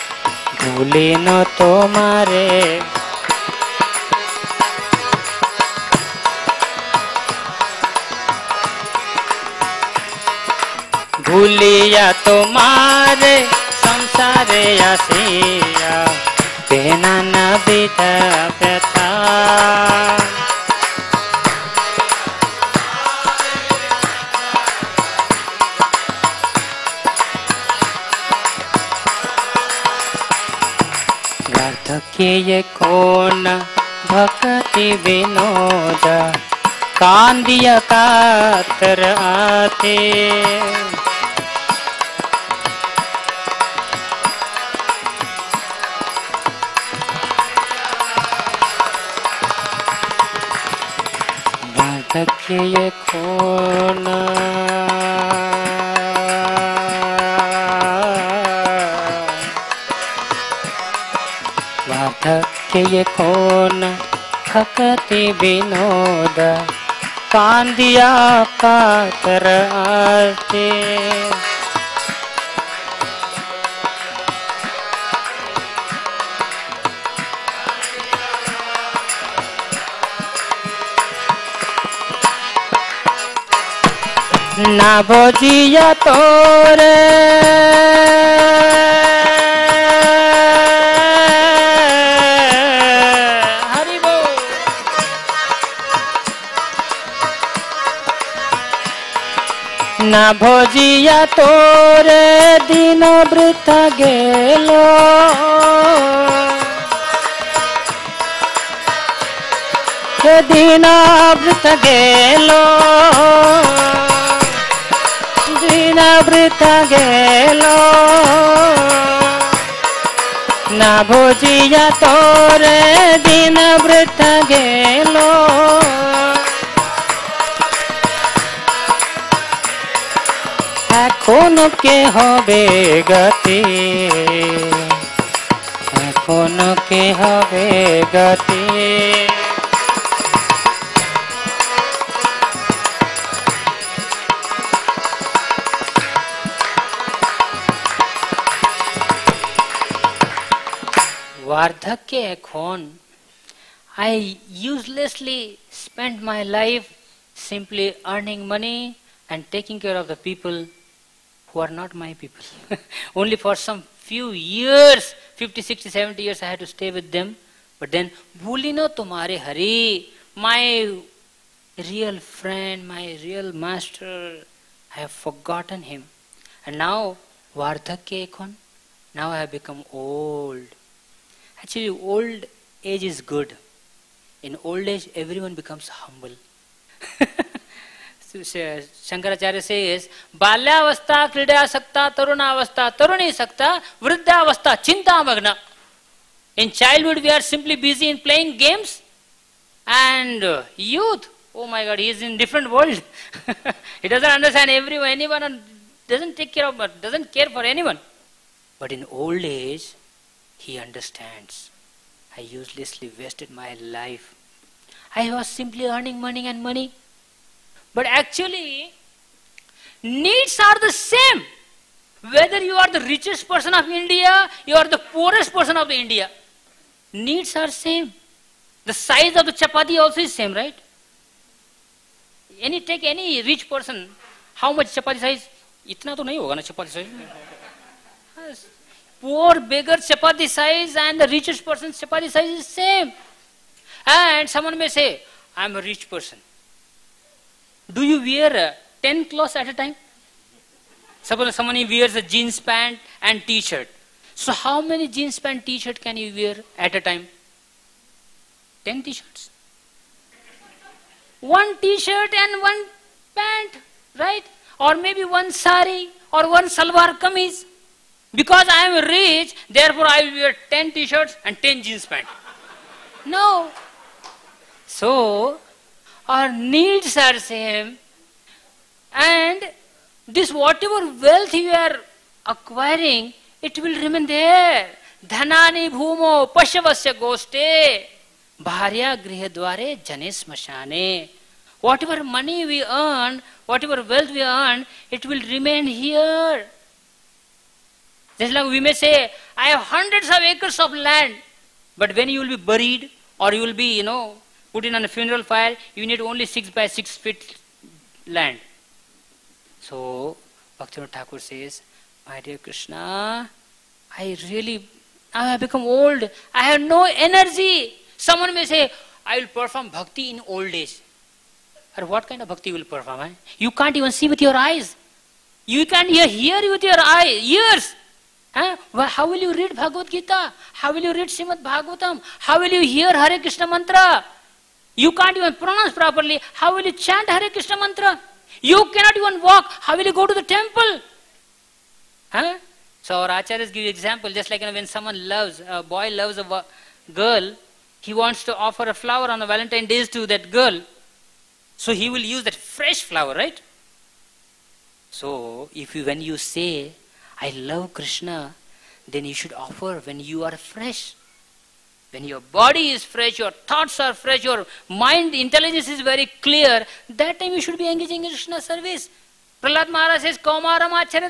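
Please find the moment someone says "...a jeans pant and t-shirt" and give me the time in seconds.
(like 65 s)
252 s.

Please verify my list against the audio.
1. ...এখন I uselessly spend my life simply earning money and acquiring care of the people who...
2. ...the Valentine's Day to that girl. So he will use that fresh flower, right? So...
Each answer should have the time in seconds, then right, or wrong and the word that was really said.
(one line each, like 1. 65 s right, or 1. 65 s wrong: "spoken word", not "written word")
1. 152 s wrong: "taking", not "acquiring"
2. 349 s right.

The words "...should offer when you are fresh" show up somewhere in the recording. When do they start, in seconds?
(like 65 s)
359 s.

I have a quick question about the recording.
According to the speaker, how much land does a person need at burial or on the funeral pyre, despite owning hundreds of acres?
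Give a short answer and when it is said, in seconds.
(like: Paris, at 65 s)
Six by six feet, at 306 s.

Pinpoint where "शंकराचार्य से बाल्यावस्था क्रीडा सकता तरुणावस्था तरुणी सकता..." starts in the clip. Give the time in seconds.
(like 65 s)
188 s.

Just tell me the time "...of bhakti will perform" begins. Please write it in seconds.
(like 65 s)
322 s.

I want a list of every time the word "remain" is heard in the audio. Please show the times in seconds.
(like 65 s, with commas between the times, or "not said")
284 s, 295 s.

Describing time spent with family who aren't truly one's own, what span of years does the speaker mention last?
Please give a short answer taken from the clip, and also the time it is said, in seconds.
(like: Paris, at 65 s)
70 years, at 165 s.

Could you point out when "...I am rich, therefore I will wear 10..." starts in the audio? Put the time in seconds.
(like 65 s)
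268 s.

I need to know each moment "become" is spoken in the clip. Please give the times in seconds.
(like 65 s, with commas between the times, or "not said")
179 s, 185 s, 315 s.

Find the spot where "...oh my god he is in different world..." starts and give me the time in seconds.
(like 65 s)
201 s.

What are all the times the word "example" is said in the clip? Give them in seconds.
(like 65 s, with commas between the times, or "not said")
343 s.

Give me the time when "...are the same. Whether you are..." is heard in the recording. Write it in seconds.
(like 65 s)
220 s.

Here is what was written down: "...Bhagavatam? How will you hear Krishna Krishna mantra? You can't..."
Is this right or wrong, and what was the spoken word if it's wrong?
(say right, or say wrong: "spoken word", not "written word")
wrong: "Hare", not "Krishna".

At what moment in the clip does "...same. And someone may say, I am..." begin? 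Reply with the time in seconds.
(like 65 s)
242 s.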